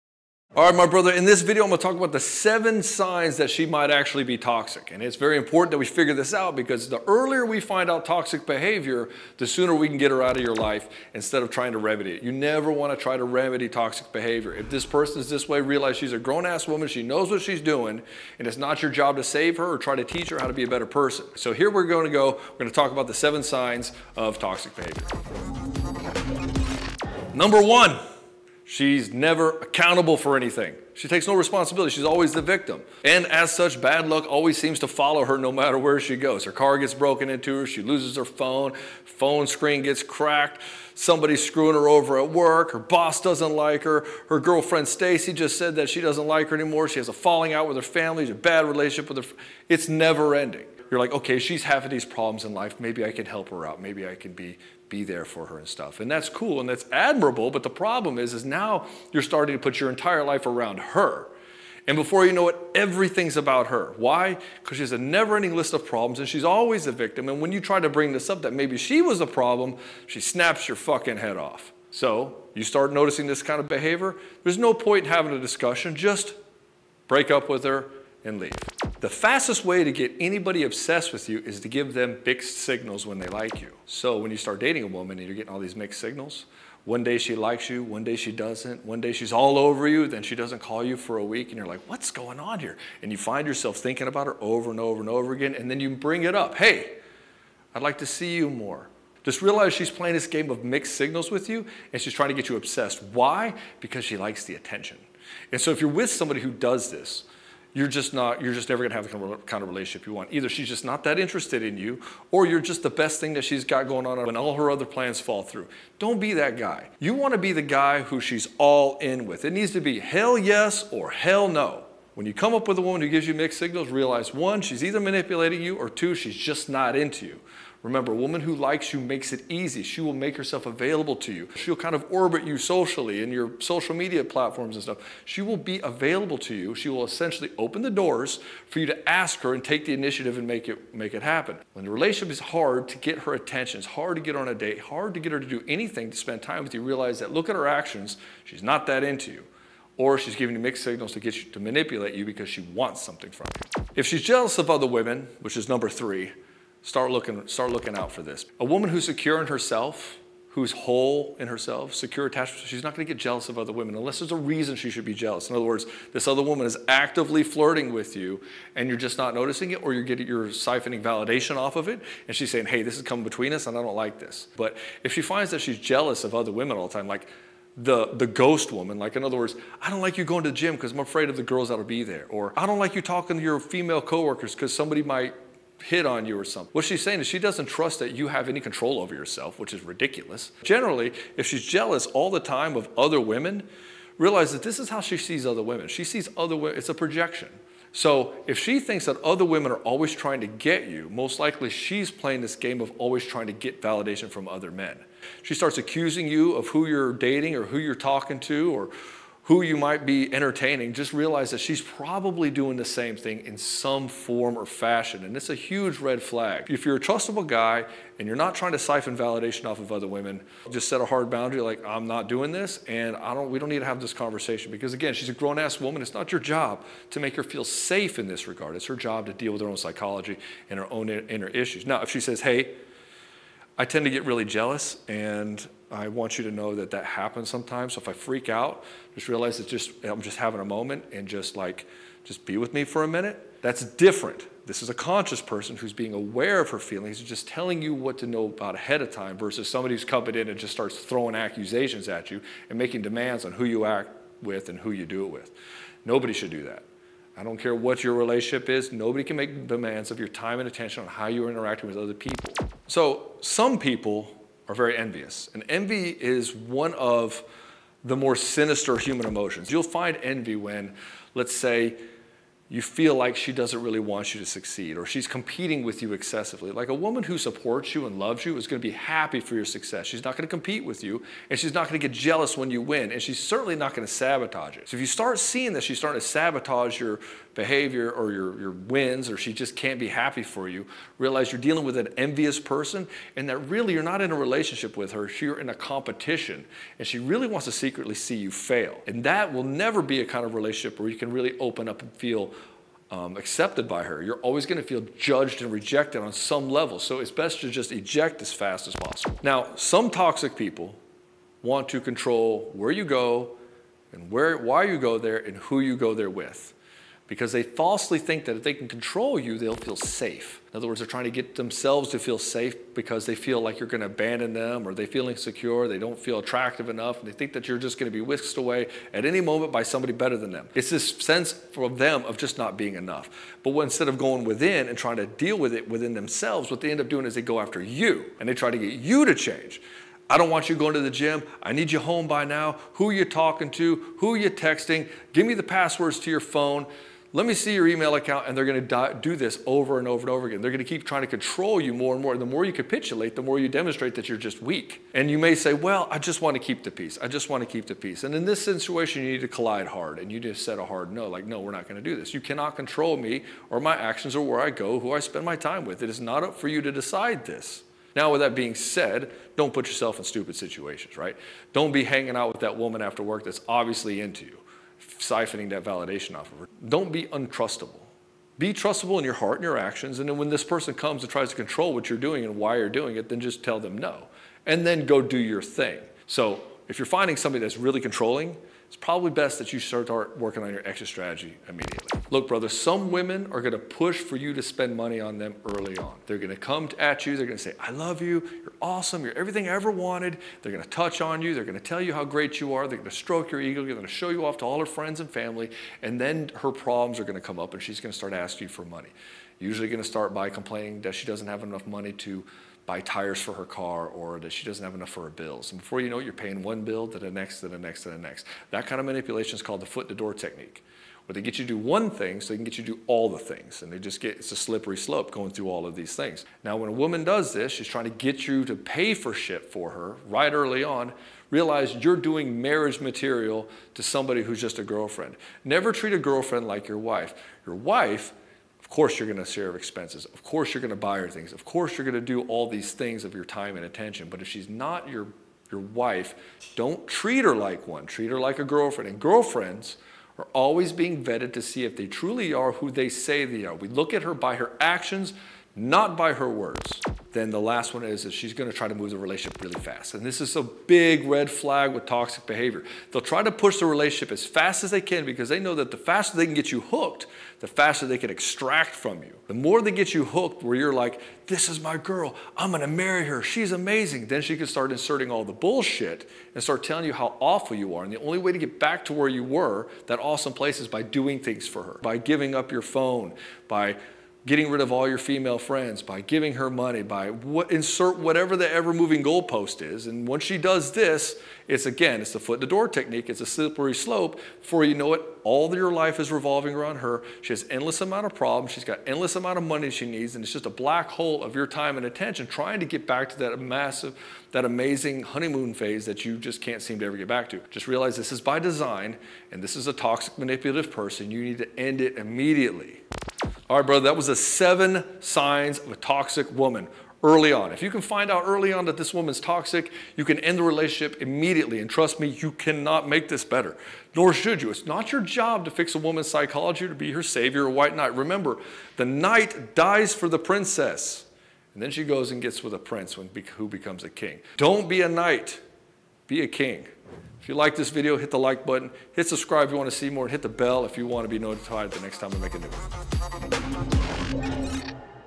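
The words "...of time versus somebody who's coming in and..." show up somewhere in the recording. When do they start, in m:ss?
4:09.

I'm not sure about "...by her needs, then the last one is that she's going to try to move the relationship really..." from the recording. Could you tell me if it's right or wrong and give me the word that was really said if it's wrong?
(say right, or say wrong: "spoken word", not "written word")
wrong: "words", not "needs".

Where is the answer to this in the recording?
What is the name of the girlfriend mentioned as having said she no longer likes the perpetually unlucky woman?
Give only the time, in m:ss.
0:44.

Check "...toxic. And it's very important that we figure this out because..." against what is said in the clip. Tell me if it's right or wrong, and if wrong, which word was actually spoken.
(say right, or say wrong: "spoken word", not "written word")
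right.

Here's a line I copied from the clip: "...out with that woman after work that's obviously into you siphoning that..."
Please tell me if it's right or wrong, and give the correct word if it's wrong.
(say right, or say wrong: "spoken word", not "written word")
right.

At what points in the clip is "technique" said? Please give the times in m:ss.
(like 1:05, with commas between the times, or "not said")
7:00, 8:12.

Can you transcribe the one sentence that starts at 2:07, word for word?
Remember, a woman who likes you makes it easy.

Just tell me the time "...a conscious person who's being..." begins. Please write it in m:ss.
4:04.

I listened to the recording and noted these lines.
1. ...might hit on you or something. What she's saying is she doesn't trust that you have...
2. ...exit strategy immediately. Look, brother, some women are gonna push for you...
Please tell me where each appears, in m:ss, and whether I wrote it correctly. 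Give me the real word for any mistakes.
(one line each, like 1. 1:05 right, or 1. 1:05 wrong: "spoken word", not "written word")
1. 3:05 right
2. 6:30 right.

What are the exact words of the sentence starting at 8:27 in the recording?
Just realize this is by design, and this is a toxic, manipulative person.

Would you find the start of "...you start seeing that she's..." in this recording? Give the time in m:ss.
4:45.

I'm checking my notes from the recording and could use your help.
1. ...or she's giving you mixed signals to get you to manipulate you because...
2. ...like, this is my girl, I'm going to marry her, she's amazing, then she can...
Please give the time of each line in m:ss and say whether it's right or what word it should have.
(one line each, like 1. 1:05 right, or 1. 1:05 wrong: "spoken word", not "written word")
1. 2:29 right
2. 7:50 right.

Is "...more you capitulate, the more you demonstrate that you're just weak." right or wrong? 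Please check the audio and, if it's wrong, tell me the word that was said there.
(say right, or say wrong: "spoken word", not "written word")
right.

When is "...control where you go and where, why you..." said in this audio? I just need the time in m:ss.
5:11.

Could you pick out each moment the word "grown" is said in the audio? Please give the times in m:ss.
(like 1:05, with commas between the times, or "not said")
0:16, 3:45.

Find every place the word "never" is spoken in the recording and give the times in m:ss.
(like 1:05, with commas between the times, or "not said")
0:12, 0:29, 0:49, 1:04, 1:48, 4:59, 7:15.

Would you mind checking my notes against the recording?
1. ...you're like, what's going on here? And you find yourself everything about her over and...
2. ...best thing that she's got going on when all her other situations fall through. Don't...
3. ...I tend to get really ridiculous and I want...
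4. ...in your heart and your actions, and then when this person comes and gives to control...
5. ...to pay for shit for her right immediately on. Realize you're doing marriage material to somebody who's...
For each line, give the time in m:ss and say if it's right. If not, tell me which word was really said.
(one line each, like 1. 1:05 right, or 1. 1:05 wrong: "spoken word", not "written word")
1. 1:31 wrong: "thinking", not "everything"
2. 1:52 wrong: "plans", not "situations"
3. 3:53 wrong: "jealous", not "ridiculous"
4. 6:19 wrong: "tries", not "gives"
5. 7:08 wrong: "early", not "immediately".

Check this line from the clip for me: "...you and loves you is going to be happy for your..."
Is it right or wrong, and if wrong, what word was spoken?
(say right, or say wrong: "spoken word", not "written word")
right.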